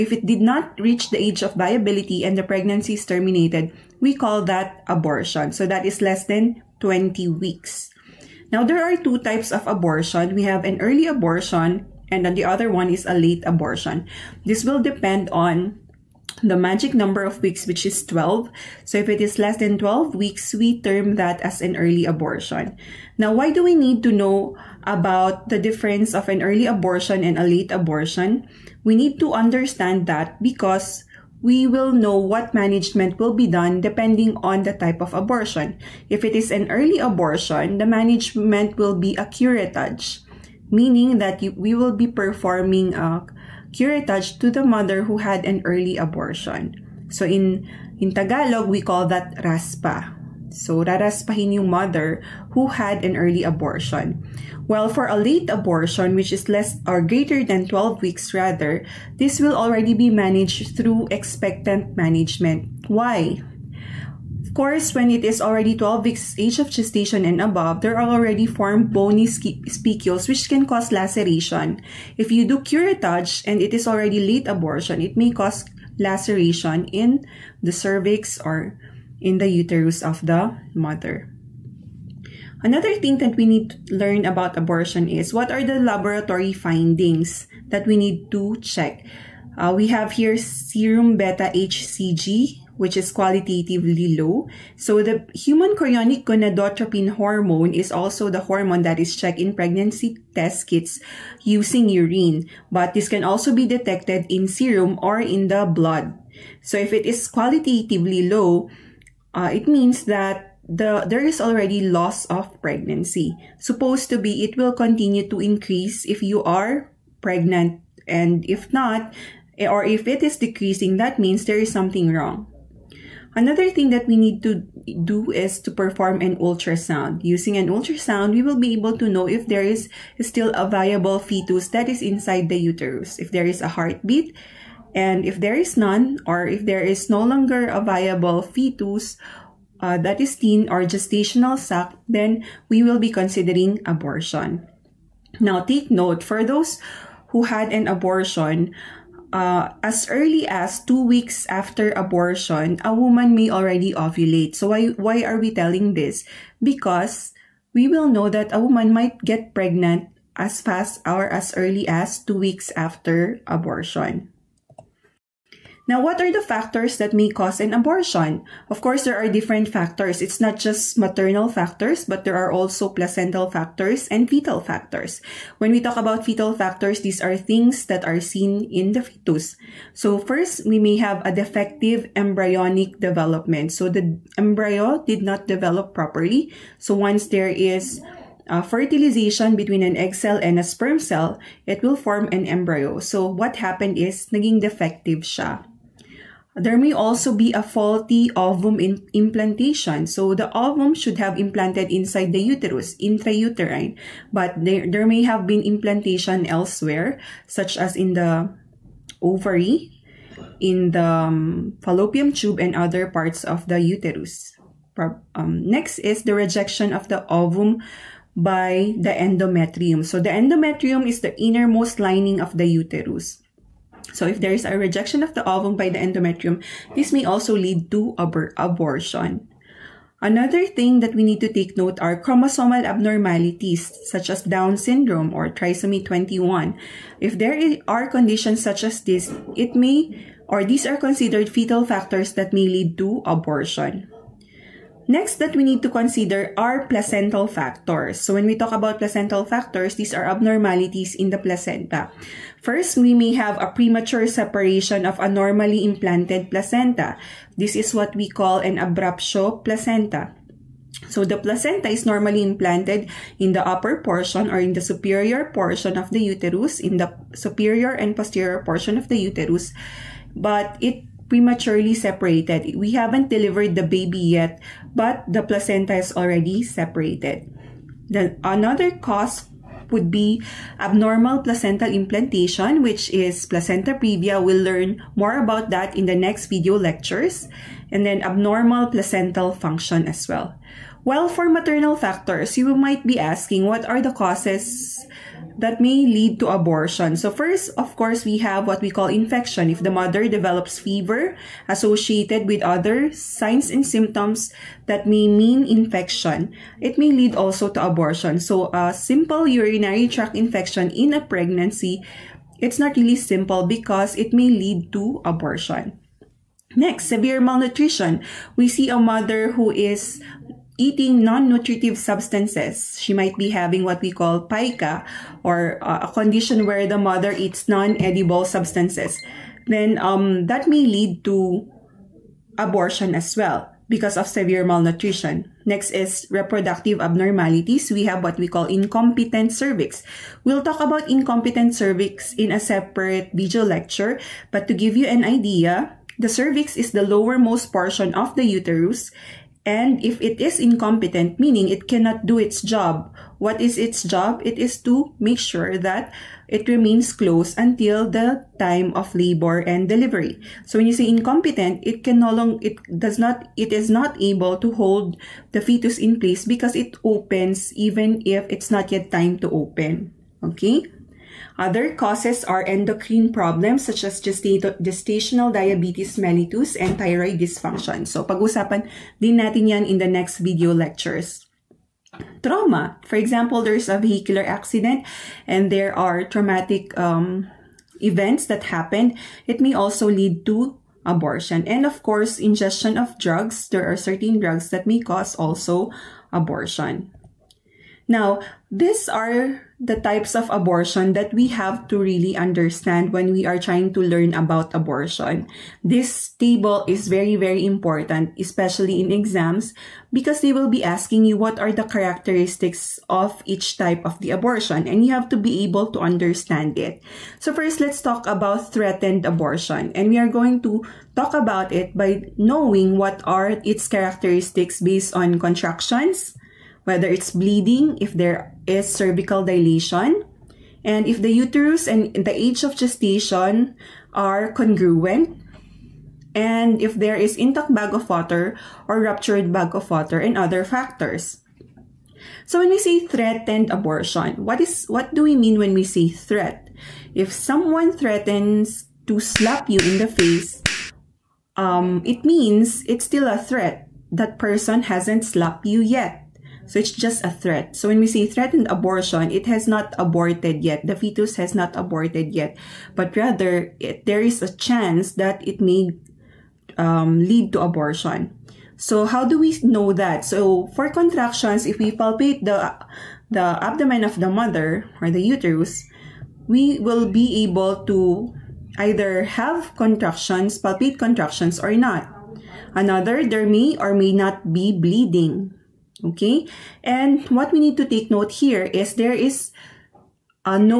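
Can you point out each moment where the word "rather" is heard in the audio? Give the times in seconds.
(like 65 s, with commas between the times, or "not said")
58 s, 463 s.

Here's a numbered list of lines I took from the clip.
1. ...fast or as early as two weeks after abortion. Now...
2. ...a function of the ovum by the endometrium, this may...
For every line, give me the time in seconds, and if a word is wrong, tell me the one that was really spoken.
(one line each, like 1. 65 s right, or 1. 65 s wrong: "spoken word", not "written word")
1. 160 s right
2. 224 s wrong: "rejection", not "function".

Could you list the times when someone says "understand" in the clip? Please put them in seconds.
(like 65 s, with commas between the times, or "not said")
29 s, 402 s, 415 s.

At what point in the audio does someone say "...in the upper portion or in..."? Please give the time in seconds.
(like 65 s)
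263 s.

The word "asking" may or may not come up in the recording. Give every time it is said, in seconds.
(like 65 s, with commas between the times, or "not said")
293 s, 410 s.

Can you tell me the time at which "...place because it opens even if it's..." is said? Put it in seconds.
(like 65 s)
366 s.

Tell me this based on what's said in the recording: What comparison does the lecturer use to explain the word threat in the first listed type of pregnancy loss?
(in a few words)
slap you in the face.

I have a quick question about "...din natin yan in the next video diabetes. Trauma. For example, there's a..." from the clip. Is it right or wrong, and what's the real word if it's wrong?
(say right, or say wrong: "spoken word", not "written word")
wrong: "lectures", not "diabetes".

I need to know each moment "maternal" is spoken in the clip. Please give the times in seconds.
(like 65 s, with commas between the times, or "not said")
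170 s, 291 s.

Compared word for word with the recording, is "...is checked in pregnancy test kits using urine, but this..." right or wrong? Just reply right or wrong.
right.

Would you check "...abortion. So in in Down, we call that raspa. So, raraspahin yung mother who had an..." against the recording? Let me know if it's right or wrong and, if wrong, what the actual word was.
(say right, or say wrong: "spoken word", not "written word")
wrong: "Tagalog", not "Down".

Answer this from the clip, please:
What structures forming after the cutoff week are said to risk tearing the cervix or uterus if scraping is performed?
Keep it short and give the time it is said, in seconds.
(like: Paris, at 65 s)
bony spicules, at 68 s.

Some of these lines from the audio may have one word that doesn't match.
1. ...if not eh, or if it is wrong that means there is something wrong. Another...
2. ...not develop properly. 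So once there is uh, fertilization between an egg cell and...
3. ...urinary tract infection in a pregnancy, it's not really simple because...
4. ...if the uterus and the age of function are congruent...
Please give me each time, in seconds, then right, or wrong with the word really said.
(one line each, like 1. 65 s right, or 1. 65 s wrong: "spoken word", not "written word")
1. 118 s wrong: "decreasing", not "wrong"
2. 185 s right
3. 309 s right
4. 431 s wrong: "gestation", not "function".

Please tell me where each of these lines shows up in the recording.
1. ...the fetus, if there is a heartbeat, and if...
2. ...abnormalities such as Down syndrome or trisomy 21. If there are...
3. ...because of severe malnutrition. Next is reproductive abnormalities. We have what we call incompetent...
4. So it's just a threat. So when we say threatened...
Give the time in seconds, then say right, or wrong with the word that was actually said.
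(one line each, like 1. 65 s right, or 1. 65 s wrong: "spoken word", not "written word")
1. 132 s wrong: "uterus", not "fetus"
2. 232 s right
3. 333 s right
4. 456 s right.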